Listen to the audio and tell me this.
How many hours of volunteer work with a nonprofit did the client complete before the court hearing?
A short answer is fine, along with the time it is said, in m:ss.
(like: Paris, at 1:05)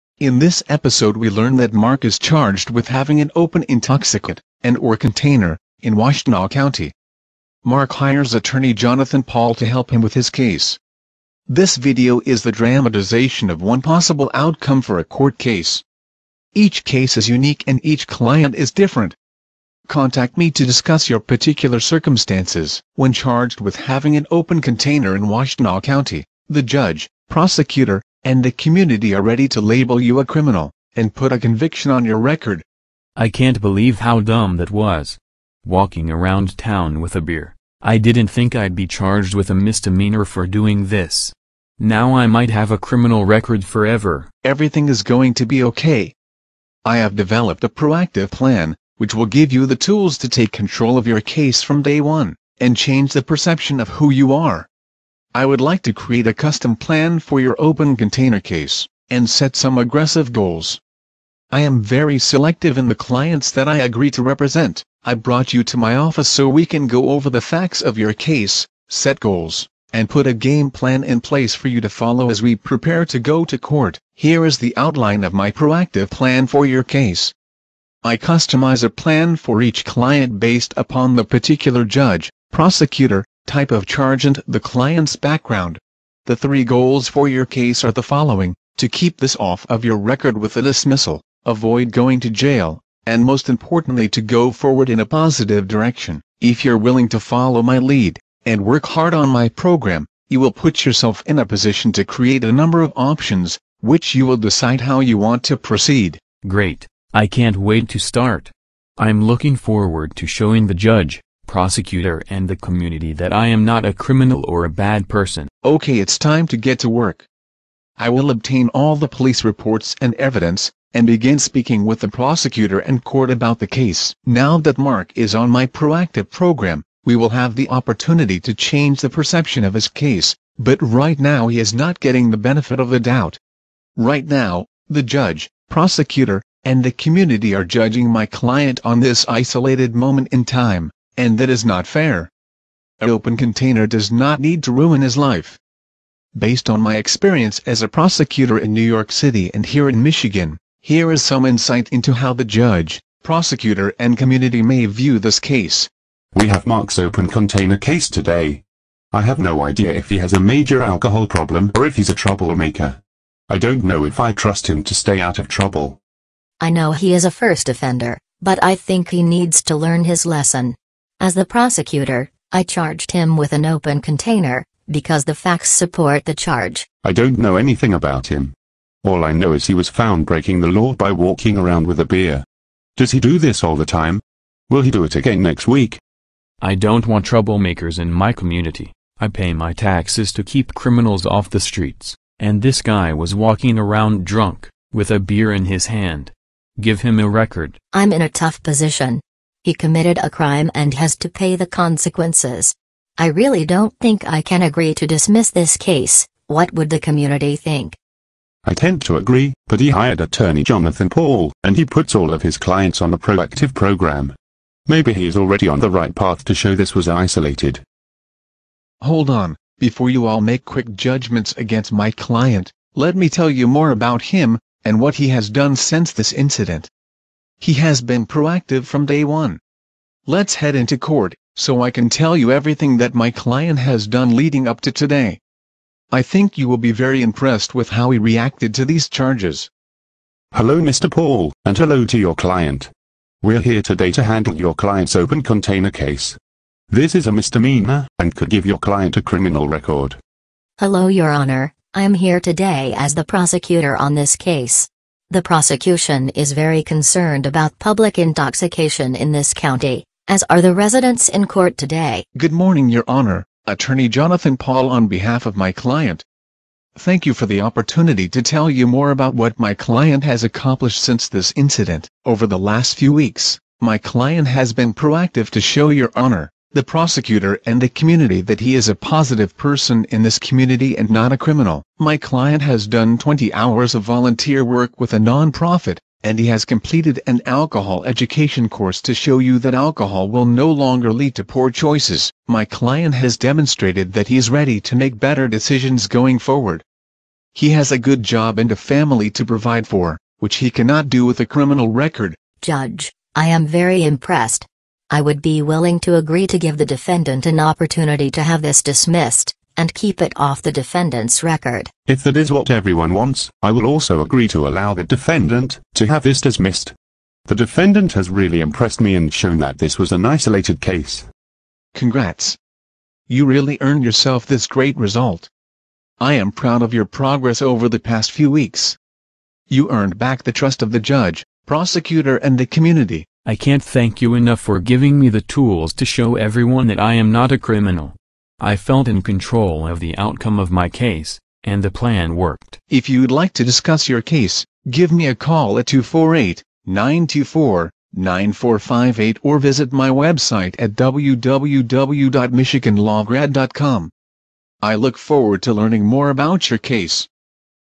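20, at 4:43.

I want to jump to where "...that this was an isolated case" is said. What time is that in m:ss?
5:19.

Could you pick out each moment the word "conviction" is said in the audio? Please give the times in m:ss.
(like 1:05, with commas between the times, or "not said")
0:31.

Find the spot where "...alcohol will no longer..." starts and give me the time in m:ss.
4:49.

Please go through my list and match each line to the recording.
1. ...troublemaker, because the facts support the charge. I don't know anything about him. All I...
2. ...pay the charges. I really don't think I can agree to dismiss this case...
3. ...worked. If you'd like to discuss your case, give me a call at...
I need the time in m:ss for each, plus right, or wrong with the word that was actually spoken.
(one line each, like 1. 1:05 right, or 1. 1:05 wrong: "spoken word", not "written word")
1. 2:54 wrong: "container", not "troublemaker"
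2. 3:21 wrong: "consequences", not "charges"
3. 5:42 right.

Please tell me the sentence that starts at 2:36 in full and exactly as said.
We have Mark's open container case today.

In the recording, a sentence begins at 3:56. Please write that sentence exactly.
I think you will be very impressed with how he reacted to these charges.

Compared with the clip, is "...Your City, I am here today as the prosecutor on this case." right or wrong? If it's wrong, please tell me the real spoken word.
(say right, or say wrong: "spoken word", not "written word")
wrong: "Honor", not "City".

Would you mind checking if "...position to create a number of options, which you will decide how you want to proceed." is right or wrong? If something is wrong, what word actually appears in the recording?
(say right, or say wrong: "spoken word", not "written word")
right.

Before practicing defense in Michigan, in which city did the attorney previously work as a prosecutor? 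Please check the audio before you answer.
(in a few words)
New York City.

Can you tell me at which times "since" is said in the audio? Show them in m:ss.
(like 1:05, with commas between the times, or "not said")
3:45, 4:31.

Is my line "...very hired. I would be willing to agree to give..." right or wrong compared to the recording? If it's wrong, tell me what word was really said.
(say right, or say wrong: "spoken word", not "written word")
wrong: "impressed", not "hired".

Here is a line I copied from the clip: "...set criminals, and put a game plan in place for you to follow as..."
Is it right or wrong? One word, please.
wrong.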